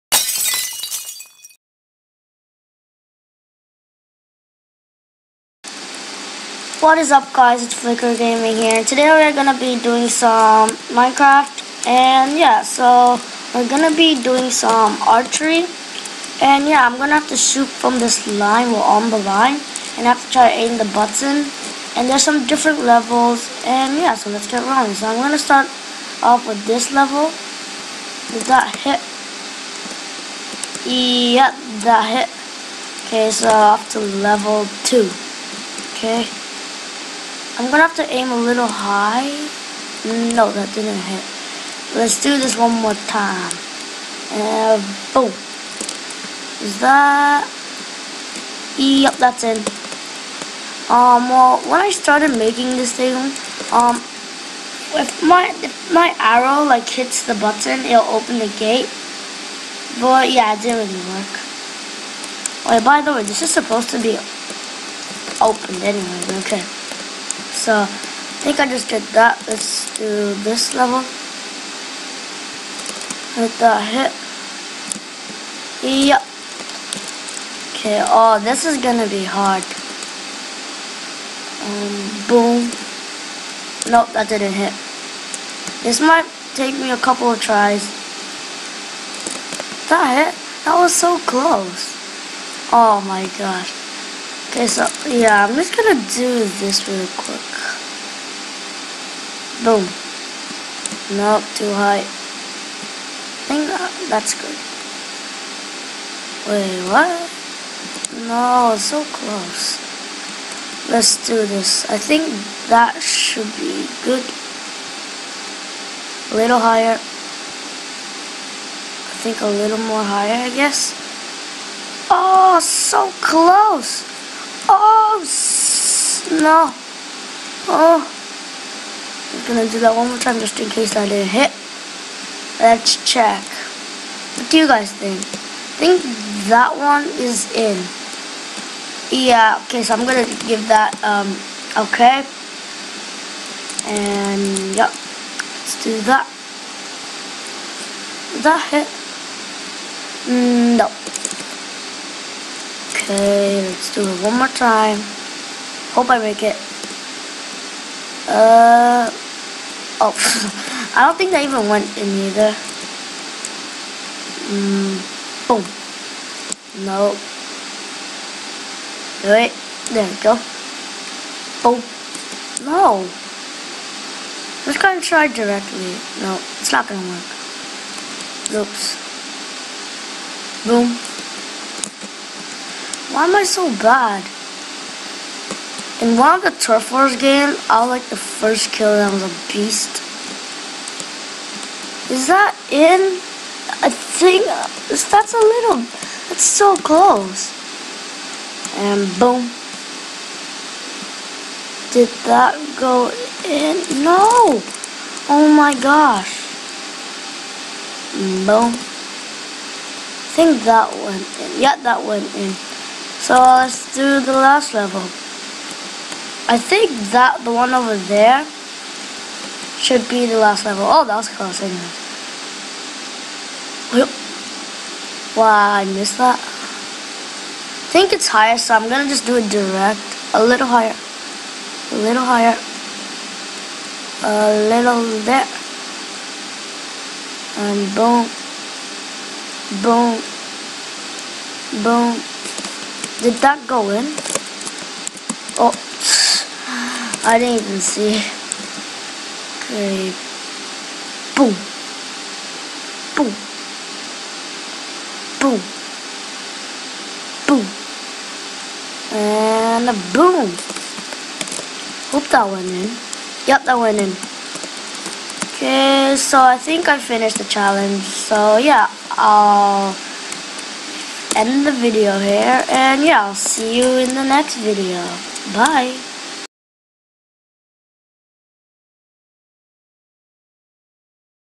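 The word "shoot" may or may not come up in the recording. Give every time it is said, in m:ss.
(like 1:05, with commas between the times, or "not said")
0:17.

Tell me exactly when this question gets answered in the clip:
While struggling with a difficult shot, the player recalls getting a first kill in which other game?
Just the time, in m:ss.
3:06.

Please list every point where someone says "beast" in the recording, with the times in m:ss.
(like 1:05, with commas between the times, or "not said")
3:09.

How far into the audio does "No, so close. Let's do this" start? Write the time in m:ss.
1:48.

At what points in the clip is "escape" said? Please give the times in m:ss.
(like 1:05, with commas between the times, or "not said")
not said.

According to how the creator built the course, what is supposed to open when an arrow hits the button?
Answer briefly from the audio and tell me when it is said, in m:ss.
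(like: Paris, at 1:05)
the gate, at 0:58.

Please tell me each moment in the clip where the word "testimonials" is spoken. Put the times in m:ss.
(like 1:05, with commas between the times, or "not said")
not said.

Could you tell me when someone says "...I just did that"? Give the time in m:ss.
1:08.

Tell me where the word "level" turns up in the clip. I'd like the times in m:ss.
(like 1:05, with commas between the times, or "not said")
0:22, 0:26, 0:33, 1:10, 3:34, 3:40.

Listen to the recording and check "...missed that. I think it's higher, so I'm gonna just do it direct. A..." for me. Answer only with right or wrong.
right.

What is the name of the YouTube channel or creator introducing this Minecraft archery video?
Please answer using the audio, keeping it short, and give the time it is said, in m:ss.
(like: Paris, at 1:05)
Flicker Gaming, at 0:07.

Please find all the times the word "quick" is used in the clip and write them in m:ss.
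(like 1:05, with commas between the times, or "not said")
1:37.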